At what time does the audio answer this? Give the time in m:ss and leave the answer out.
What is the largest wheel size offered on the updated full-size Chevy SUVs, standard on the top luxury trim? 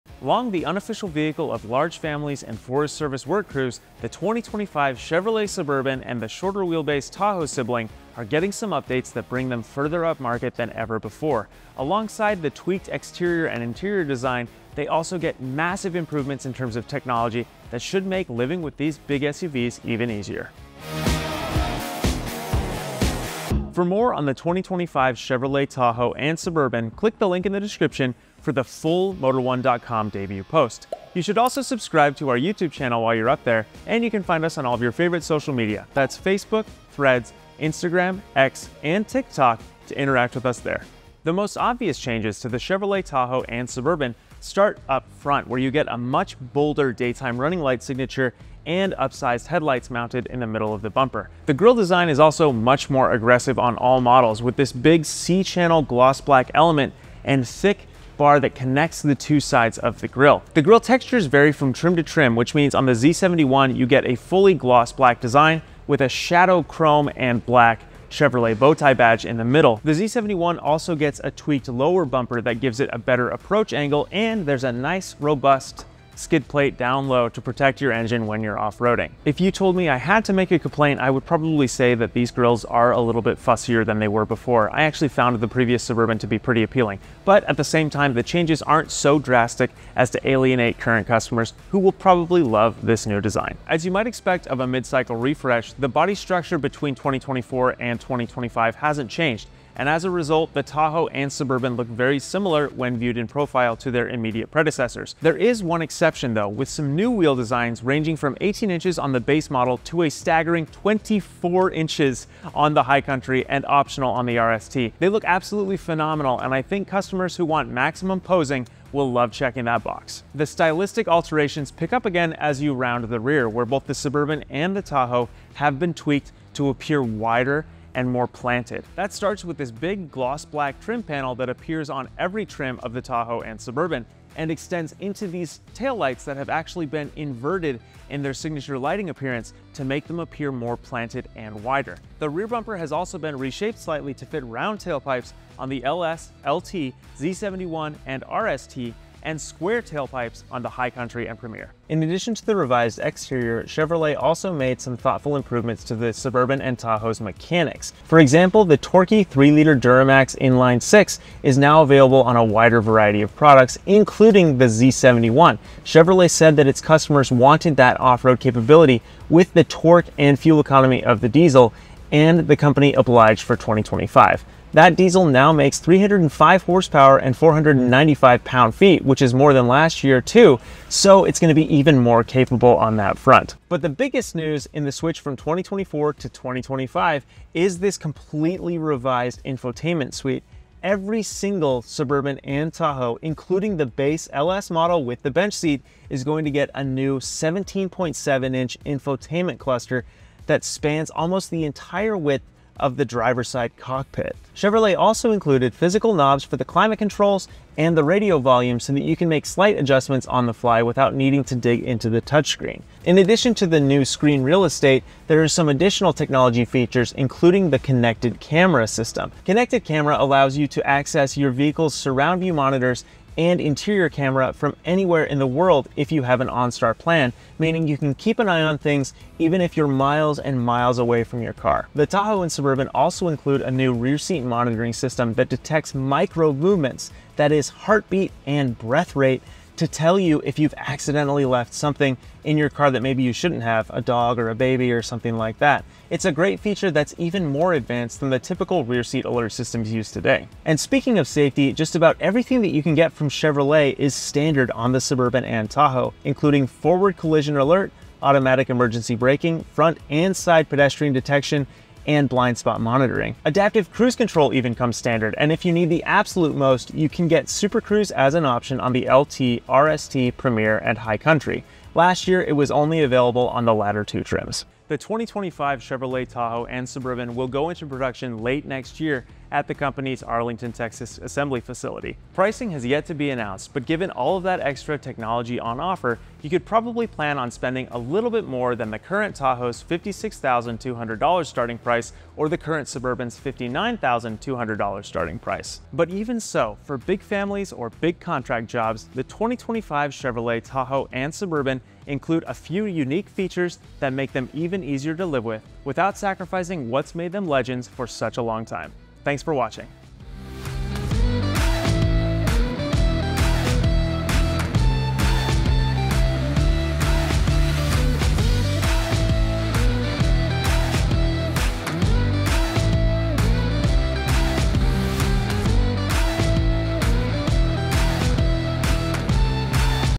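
1:50.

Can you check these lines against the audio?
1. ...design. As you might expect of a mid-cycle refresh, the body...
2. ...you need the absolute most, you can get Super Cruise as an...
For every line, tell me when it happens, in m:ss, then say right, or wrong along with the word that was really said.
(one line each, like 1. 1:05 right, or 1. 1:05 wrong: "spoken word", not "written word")
1. 1:33 right
2. 4:25 right.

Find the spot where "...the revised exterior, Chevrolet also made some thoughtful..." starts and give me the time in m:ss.
2:32.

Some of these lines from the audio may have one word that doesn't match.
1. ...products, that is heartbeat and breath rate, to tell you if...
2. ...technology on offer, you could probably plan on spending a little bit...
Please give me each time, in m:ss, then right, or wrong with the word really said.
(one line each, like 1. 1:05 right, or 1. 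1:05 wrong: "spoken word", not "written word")
1. 3:56 wrong: "movements", not "products"
2. 4:44 right.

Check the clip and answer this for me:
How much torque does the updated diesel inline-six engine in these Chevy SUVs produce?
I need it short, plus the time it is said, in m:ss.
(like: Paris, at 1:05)
495 pound-feet, at 2:57.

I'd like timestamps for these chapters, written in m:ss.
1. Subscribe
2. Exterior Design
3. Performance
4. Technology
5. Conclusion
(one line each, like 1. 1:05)
1. 0:23
2. 0:41
3. 2:32
4. 3:05
5. 4:34.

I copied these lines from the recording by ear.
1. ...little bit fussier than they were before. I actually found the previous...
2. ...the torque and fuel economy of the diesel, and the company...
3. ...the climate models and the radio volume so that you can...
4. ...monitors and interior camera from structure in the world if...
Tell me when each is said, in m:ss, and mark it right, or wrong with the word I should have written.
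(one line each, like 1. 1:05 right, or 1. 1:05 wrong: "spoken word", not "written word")
1. 1:23 right
2. 2:49 right
3. 3:26 wrong: "controls", not "models"
4. 3:42 wrong: "anywhere", not "structure".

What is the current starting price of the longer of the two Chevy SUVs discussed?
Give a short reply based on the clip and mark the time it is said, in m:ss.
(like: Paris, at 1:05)
$59,200, at 4:53.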